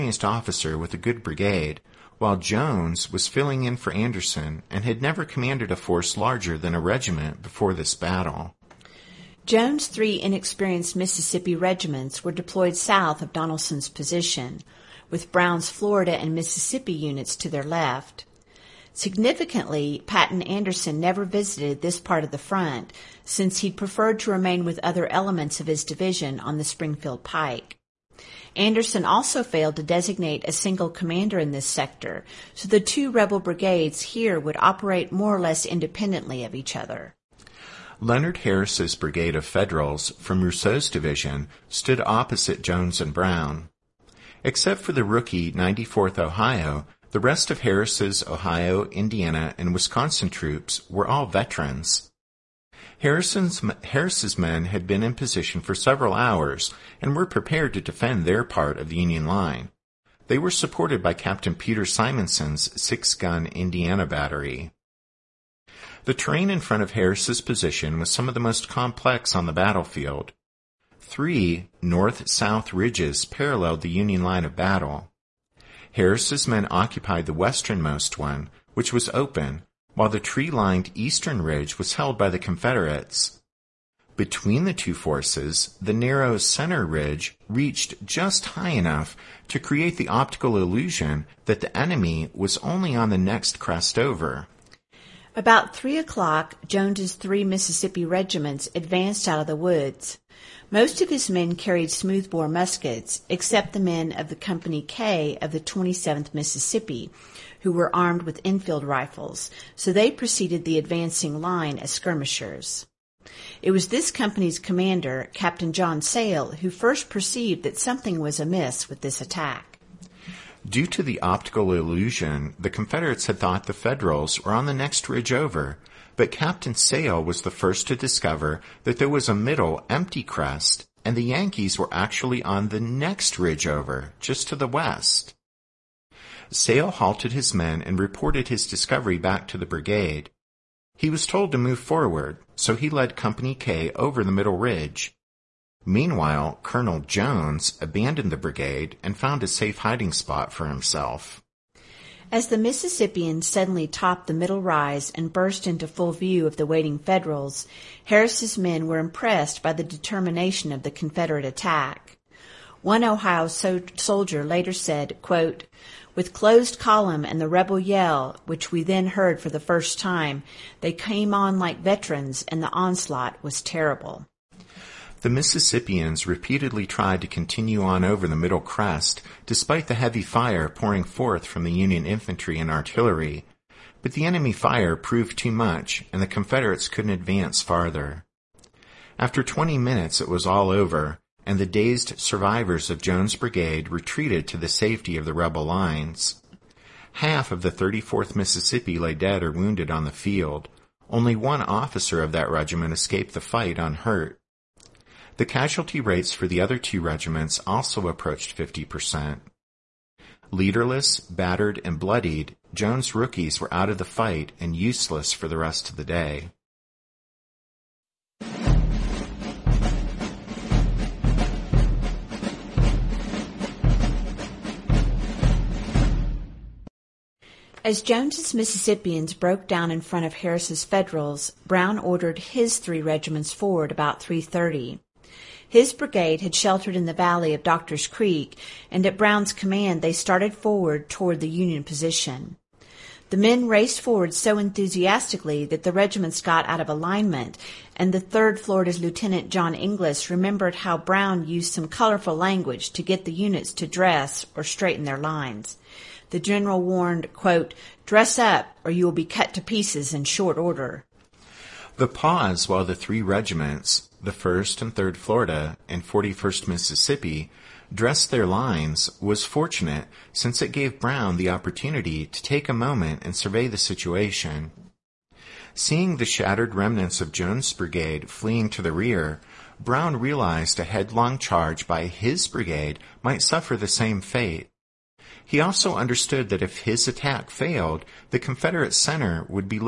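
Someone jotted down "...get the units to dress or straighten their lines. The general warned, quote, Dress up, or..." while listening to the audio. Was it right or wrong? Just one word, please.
right.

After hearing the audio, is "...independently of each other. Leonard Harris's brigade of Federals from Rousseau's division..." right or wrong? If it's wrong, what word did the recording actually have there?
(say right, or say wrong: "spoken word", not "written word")
right.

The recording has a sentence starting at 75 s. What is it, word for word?
Harris's men occupied the westernmost one, which was open, while the tree-lined eastern ridge was held by the Confederates.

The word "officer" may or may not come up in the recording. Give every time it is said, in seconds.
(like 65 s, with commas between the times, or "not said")
0 s, 201 s.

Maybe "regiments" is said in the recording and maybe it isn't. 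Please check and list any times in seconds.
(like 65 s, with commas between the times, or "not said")
6 s, 11 s, 98 s, 202 s, 206 s, 233 s, 245 s, 263 s.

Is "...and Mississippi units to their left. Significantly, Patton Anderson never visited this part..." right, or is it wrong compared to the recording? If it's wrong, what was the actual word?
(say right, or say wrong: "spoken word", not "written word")
right.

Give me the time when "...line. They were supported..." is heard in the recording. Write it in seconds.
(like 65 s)
59 s.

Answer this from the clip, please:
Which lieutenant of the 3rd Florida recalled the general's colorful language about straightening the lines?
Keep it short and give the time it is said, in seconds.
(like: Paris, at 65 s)
John Inglis, at 249 s.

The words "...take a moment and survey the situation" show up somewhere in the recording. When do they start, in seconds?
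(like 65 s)
272 s.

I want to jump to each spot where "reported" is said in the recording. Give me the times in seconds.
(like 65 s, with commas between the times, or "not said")
137 s.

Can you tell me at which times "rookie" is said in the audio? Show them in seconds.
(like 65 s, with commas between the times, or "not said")
45 s, 213 s.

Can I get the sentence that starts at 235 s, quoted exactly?
His brigade had sheltered in the valley of Doctor's Creek, and at Brown's command they started forward toward the Union position.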